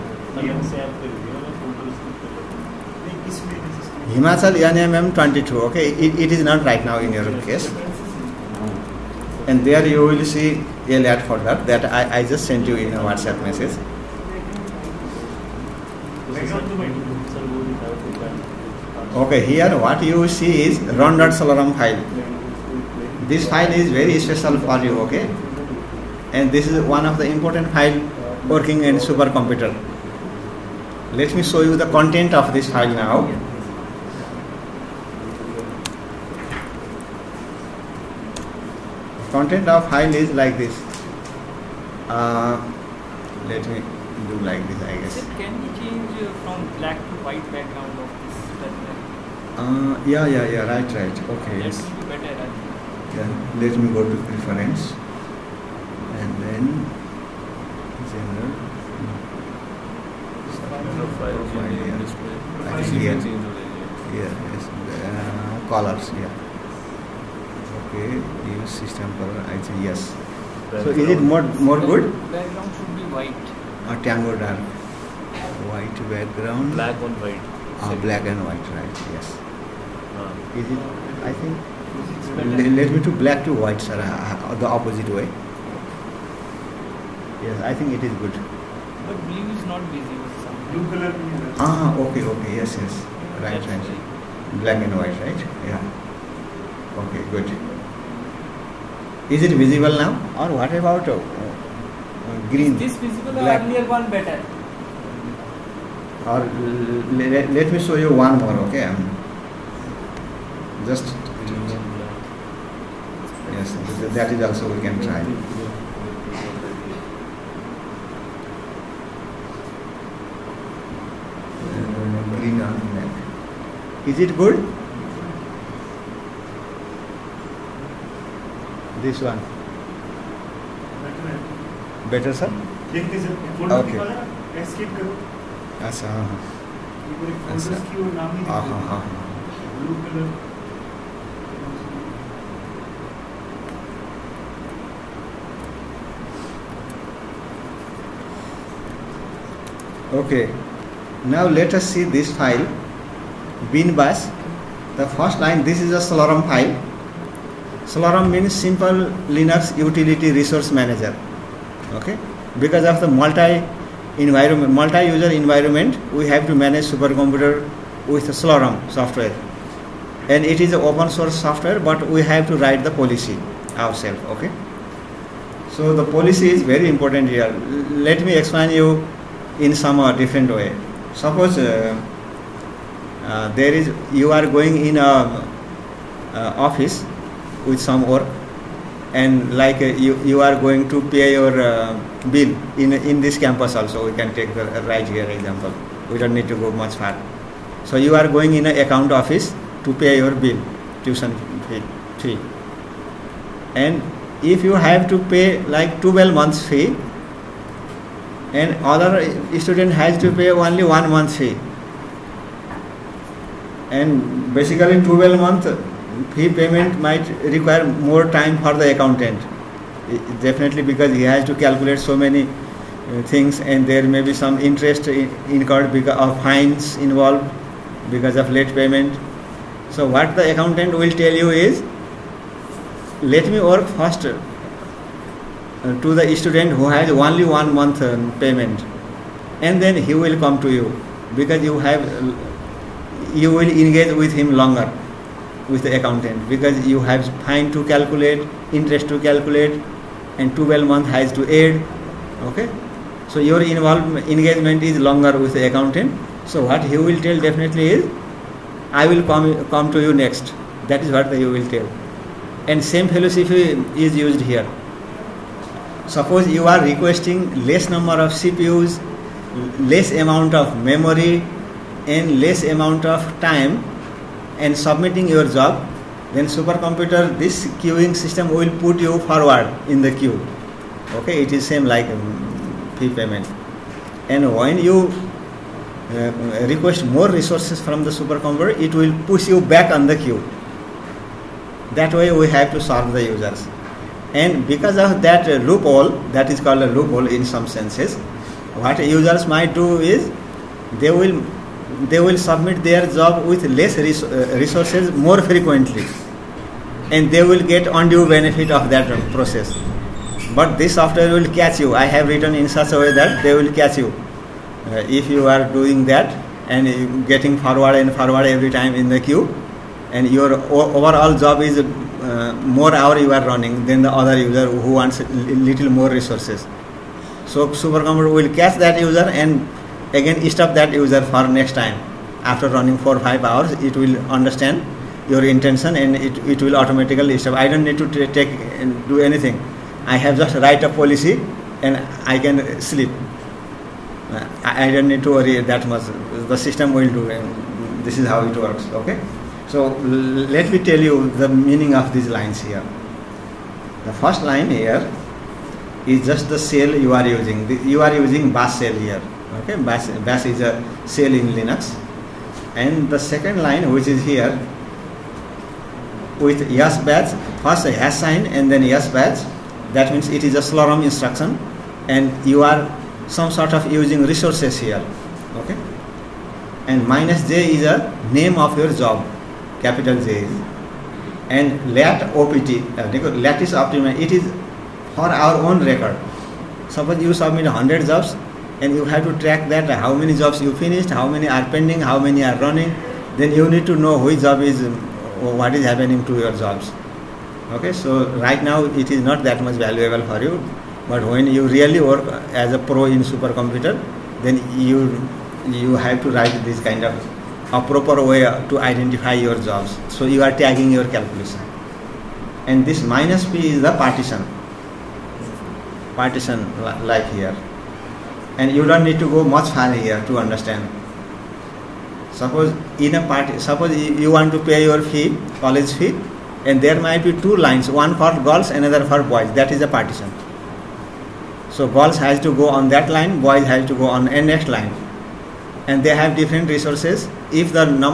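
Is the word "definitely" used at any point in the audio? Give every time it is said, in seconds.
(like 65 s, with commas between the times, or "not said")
220 s, 257 s.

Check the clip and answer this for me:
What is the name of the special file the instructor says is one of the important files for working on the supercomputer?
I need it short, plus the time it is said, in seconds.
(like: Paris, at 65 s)
run.slurm, at 21 s.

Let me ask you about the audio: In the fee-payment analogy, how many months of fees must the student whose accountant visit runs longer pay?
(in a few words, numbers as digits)
12.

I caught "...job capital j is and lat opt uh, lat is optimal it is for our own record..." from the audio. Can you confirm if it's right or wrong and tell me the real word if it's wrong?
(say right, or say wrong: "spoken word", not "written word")
right.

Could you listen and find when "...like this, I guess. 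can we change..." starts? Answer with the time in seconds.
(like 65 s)
44 s.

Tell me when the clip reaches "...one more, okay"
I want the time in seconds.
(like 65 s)
108 s.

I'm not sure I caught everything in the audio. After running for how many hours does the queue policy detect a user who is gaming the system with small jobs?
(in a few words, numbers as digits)
5.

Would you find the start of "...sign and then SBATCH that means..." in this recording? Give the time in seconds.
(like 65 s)
368 s.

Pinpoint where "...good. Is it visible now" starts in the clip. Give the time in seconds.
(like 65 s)
97 s.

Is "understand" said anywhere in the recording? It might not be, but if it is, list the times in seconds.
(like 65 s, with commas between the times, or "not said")
334 s, 420 s.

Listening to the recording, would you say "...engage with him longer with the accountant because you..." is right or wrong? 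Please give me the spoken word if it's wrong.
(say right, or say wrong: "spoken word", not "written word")
right.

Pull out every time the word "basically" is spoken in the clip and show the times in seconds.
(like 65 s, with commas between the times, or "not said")
214 s.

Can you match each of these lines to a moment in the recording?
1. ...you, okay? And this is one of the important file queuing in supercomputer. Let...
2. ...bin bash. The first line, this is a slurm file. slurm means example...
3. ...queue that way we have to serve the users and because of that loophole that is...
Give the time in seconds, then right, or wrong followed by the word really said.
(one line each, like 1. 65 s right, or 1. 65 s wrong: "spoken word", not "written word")
1. 24 s wrong: "working", not "queuing"
2. 153 s wrong: "simple", not "example"
3. 290 s right.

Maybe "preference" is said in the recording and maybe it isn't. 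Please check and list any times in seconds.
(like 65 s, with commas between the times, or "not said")
54 s.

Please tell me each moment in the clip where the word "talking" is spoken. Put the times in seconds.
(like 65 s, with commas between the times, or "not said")
not said.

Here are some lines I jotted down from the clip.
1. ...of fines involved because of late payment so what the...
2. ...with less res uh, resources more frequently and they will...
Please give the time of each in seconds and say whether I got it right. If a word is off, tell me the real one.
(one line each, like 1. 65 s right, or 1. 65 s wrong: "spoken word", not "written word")
1. 226 s right
2. 303 s right.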